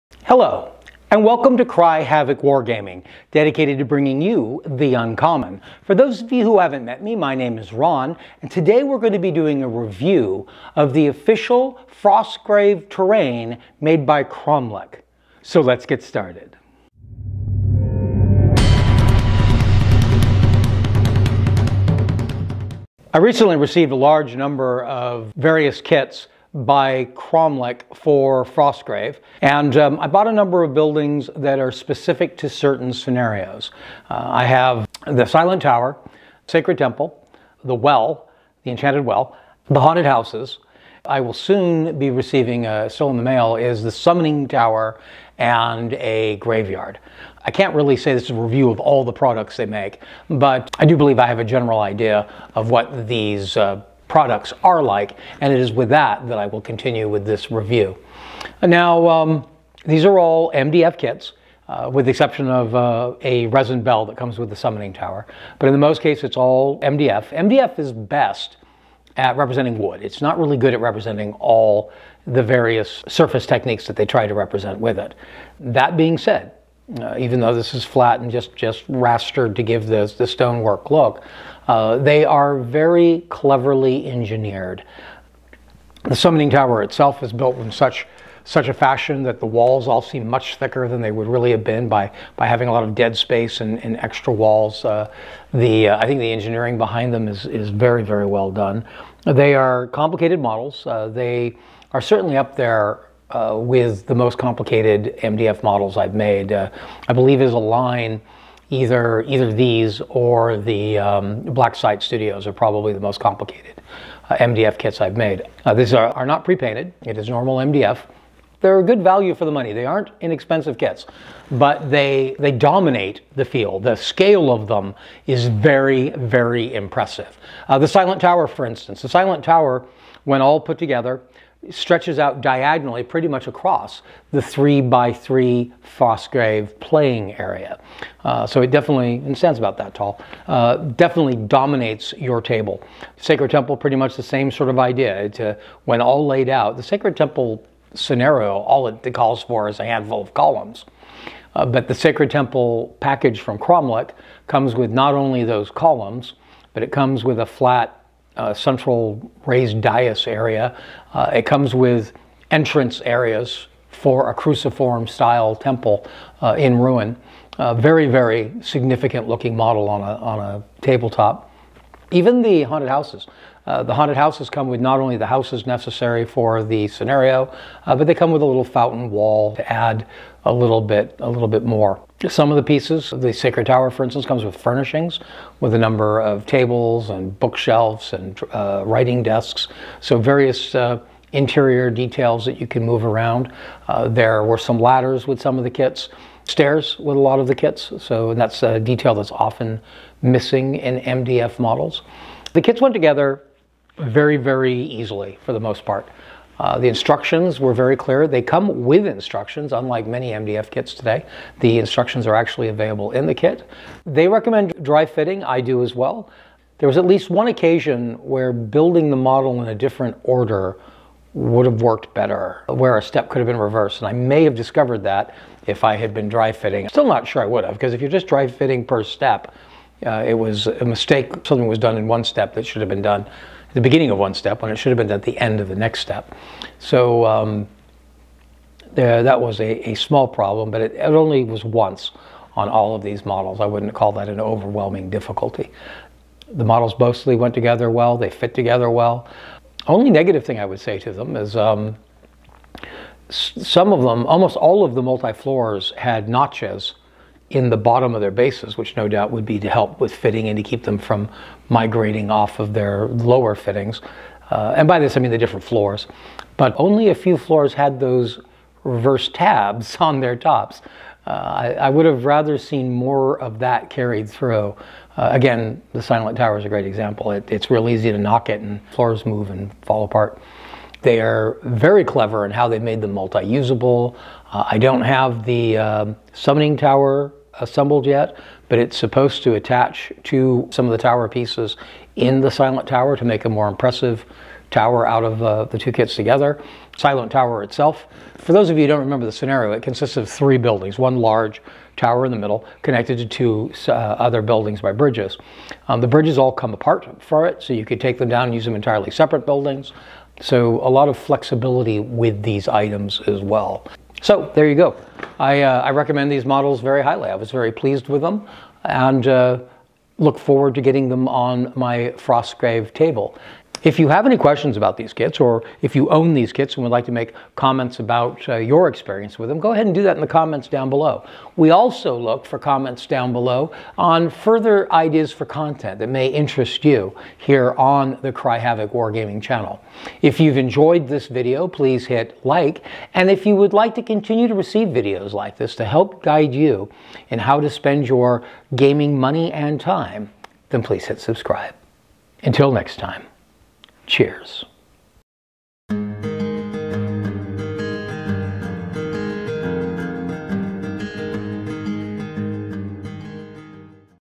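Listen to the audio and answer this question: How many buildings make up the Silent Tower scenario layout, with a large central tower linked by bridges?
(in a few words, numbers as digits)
3.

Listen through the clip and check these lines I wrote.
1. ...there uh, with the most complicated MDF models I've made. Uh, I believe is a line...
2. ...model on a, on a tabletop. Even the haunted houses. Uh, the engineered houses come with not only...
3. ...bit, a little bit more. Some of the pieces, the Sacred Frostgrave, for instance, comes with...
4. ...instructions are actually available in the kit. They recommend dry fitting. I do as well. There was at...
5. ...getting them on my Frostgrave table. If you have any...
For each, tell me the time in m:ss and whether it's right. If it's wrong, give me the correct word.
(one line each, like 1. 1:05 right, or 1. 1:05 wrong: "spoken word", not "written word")
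1. 1:42 right
2. 2:49 wrong: "haunted", not "engineered"
3. 3:00 wrong: "Tower", not "Frostgrave"
4. 3:31 right
5. 5:20 right.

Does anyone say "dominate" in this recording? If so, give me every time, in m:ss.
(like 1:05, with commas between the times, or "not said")
2:02, 2:21.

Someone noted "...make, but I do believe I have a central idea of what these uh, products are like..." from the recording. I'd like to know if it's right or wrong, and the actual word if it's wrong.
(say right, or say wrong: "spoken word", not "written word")
wrong: "general", not "central".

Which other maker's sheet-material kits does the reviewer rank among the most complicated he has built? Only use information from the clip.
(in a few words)
Black Site Studios.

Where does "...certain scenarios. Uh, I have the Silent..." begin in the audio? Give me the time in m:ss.
0:32.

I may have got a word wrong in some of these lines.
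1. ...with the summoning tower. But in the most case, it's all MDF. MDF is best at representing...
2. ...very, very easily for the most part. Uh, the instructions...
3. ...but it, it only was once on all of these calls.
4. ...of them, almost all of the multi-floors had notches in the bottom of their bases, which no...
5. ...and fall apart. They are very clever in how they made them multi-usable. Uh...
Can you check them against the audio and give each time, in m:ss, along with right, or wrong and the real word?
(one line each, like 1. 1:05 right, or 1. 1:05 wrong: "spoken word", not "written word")
1. 1:04 right
2. 3:23 right
3. 4:00 wrong: "models", not "calls"
4. 4:13 right
5. 4:39 right.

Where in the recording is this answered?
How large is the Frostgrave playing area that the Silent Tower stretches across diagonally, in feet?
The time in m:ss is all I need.
2:14.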